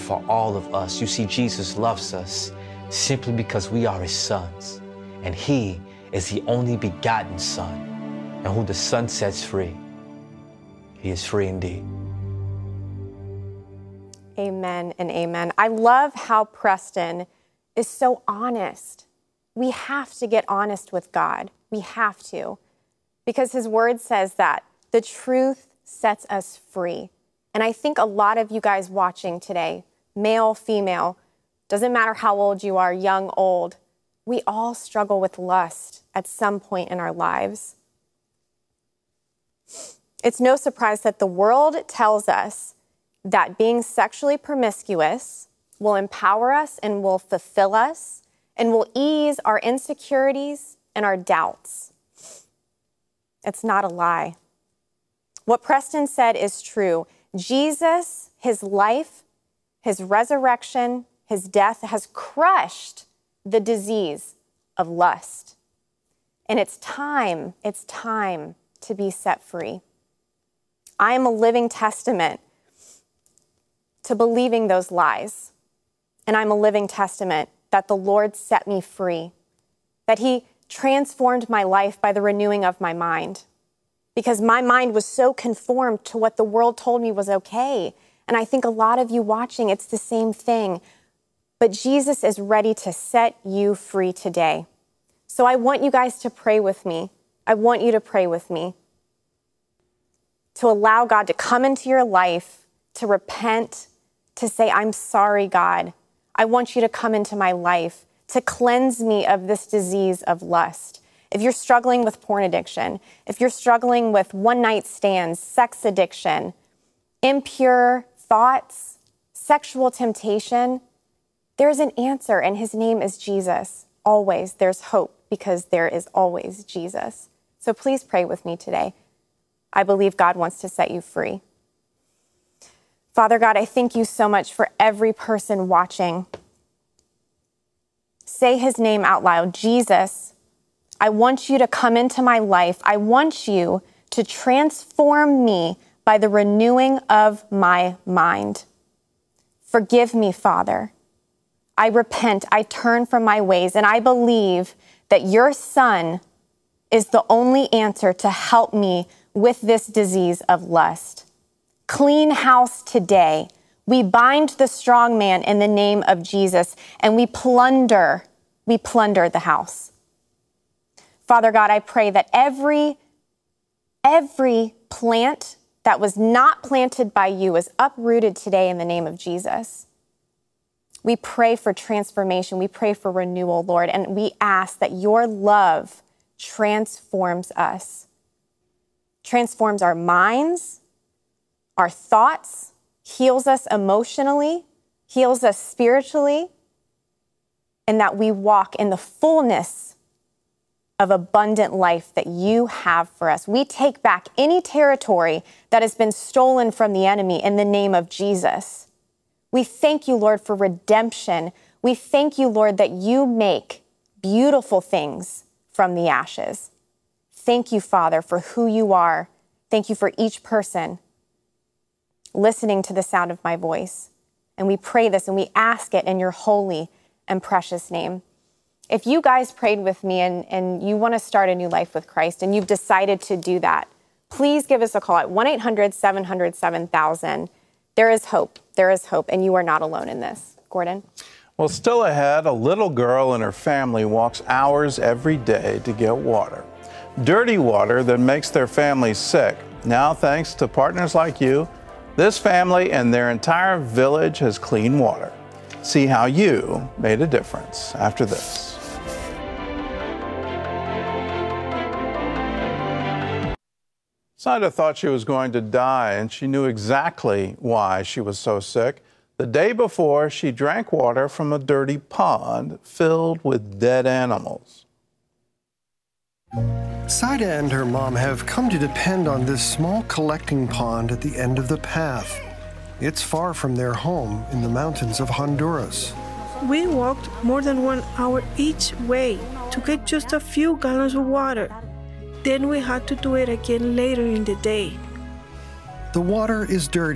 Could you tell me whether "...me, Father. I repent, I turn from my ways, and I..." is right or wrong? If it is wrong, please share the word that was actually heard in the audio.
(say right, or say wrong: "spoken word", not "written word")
right.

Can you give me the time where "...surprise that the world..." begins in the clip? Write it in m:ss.
0:40.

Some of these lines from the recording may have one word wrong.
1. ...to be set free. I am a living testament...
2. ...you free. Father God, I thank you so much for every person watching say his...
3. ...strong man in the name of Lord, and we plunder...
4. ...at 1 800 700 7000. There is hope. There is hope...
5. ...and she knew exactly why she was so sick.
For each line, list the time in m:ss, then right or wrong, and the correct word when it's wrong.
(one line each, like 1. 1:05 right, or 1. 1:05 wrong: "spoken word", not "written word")
1. 1:08 right
2. 2:10 right
3. 2:44 wrong: "Jesus", not "Lord"
4. 3:55 right
5. 4:26 right.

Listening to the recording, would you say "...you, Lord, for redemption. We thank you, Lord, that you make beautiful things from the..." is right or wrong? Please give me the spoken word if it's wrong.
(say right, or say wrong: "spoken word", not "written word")
right.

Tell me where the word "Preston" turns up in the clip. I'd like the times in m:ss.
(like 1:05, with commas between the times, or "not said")
0:16, 0:55.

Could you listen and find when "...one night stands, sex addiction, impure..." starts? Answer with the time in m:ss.
1:54.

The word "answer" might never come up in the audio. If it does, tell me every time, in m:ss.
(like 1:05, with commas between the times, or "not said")
2:01, 2:37.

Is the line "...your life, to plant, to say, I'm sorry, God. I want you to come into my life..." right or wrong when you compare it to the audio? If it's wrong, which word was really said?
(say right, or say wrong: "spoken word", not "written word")
wrong: "repent", not "plant".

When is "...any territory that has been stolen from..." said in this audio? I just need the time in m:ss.
3:24.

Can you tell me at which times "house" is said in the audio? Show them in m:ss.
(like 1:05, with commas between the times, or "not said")
2:42, 2:49.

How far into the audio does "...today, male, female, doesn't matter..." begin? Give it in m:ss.
0:29.